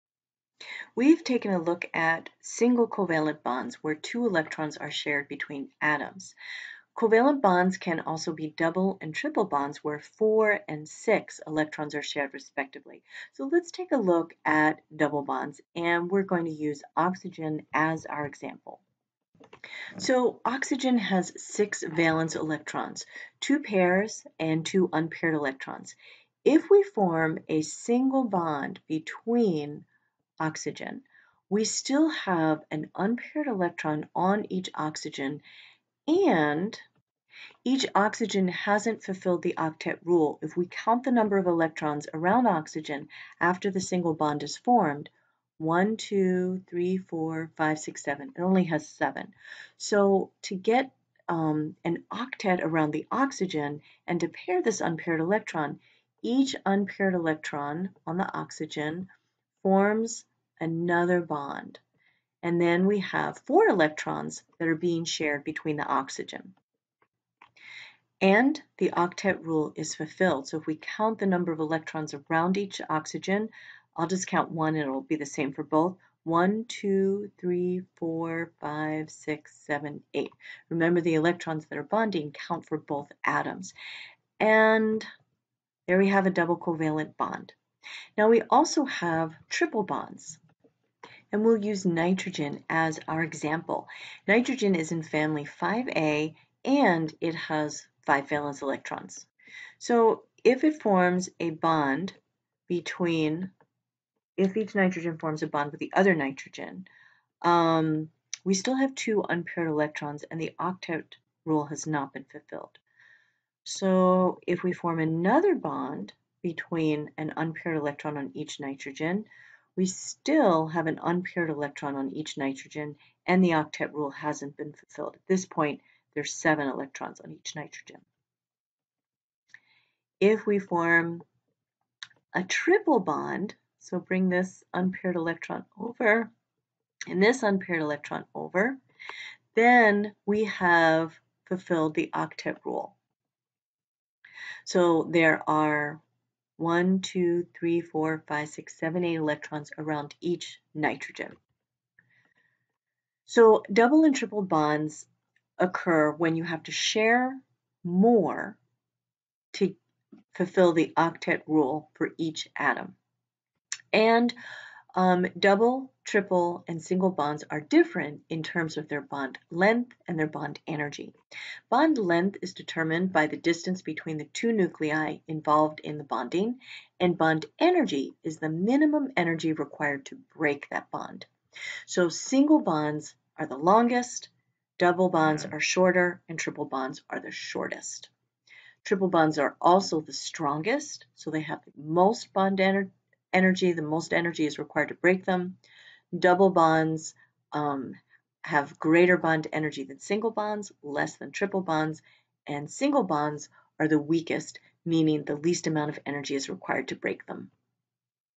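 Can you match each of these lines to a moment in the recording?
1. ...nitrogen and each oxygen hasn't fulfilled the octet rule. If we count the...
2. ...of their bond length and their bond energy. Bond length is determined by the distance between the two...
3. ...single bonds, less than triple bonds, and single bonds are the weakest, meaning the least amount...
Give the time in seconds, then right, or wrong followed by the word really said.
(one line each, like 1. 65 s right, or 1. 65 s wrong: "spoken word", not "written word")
1. 34 s wrong: "oxygen", not "nitrogen"
2. 168 s right
3. 199 s right.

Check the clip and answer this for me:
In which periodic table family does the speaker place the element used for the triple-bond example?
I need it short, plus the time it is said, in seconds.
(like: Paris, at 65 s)
5A, at 95 s.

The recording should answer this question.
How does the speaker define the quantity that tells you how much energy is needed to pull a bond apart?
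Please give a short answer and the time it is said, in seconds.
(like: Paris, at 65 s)
Minimum energy required, at 178 s.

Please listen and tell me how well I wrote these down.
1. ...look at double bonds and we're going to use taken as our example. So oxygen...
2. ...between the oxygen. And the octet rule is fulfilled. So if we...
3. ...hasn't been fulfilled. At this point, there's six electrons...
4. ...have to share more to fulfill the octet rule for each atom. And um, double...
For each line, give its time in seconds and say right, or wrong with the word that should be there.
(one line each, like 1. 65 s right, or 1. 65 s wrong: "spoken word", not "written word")
1. 13 s wrong: "oxygen", not "taken"
2. 65 s right
3. 124 s wrong: "seven", not "six"
4. 156 s right.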